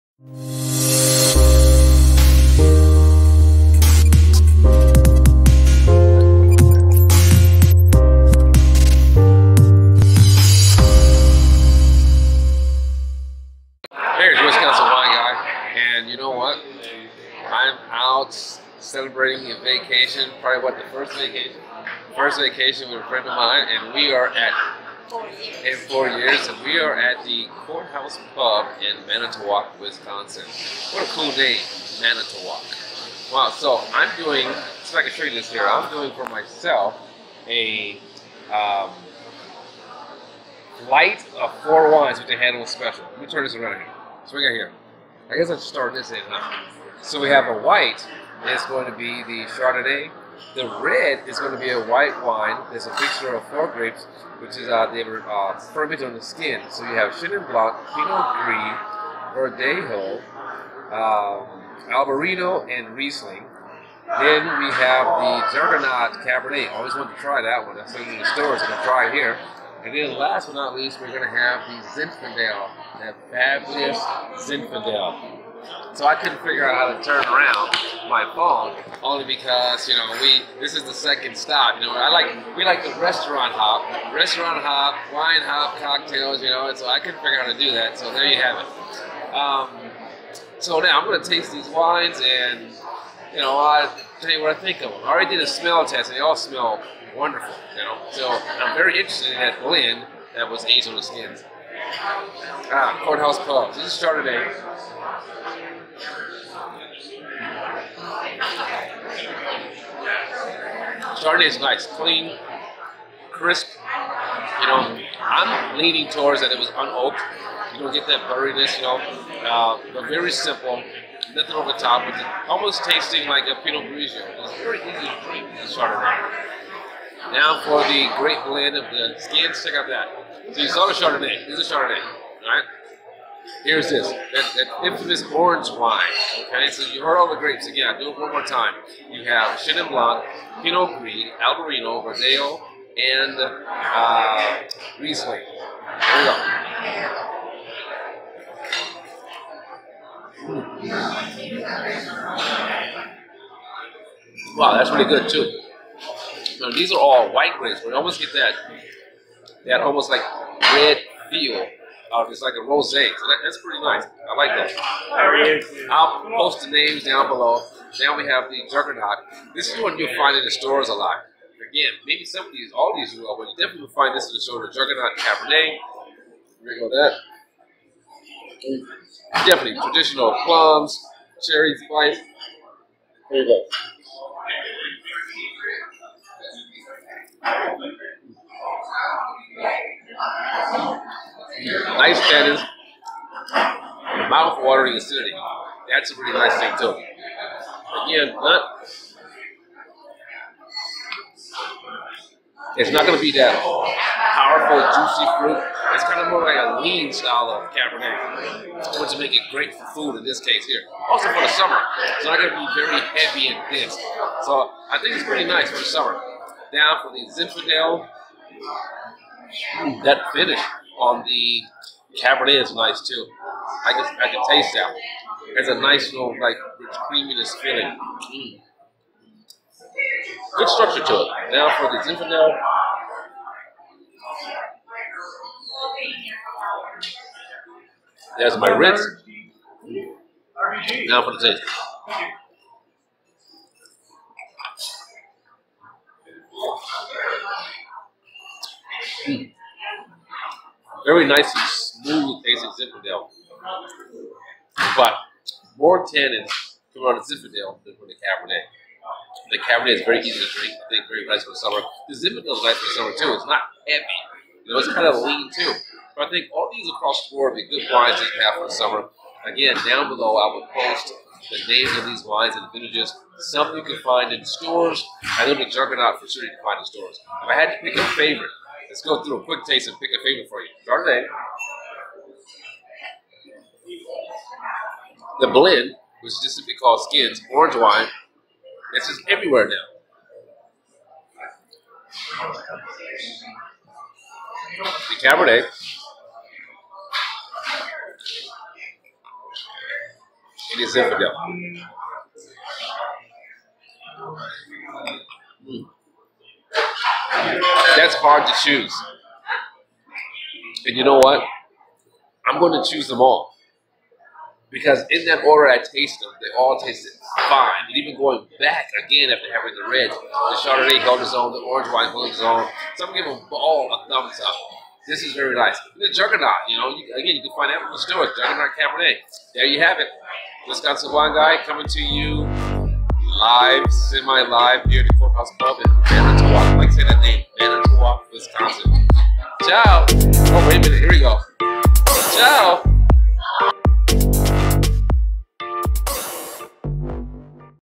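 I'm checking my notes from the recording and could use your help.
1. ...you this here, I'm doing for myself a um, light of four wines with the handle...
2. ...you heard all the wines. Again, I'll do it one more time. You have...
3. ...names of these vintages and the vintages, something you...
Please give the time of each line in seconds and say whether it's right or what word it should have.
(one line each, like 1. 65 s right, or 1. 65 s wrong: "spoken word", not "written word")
1. 35 s right
2. 136 s wrong: "grapes", not "wines"
3. 271 s wrong: "wines", not "vintages".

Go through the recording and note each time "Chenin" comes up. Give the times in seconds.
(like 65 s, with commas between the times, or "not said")
57 s, 139 s.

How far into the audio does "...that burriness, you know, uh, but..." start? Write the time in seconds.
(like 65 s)
118 s.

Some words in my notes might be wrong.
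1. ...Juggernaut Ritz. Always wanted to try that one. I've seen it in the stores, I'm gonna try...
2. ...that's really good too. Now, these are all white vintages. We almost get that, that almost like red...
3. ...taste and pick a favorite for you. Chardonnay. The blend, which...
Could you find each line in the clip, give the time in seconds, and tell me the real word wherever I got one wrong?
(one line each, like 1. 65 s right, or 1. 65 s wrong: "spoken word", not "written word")
1. 65 s wrong: "Cabernet", not "Ritz"
2. 154 s wrong: "grapes", not "vintages"
3. 279 s right.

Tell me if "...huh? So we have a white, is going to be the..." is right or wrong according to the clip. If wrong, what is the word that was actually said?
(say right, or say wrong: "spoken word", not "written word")
right.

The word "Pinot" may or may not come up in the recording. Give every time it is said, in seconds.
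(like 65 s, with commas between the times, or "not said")
57 s, 123 s, 140 s.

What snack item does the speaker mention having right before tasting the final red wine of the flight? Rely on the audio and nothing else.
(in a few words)
Ritz.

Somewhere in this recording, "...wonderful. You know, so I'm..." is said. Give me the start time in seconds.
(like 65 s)
97 s.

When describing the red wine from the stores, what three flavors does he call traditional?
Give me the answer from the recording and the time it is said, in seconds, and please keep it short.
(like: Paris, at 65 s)
plums, cherry, spice, at 180 s.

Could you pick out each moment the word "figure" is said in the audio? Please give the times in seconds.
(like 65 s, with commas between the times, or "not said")
76 s, 87 s.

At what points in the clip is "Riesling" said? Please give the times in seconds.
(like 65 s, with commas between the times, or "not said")
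62 s, 144 s.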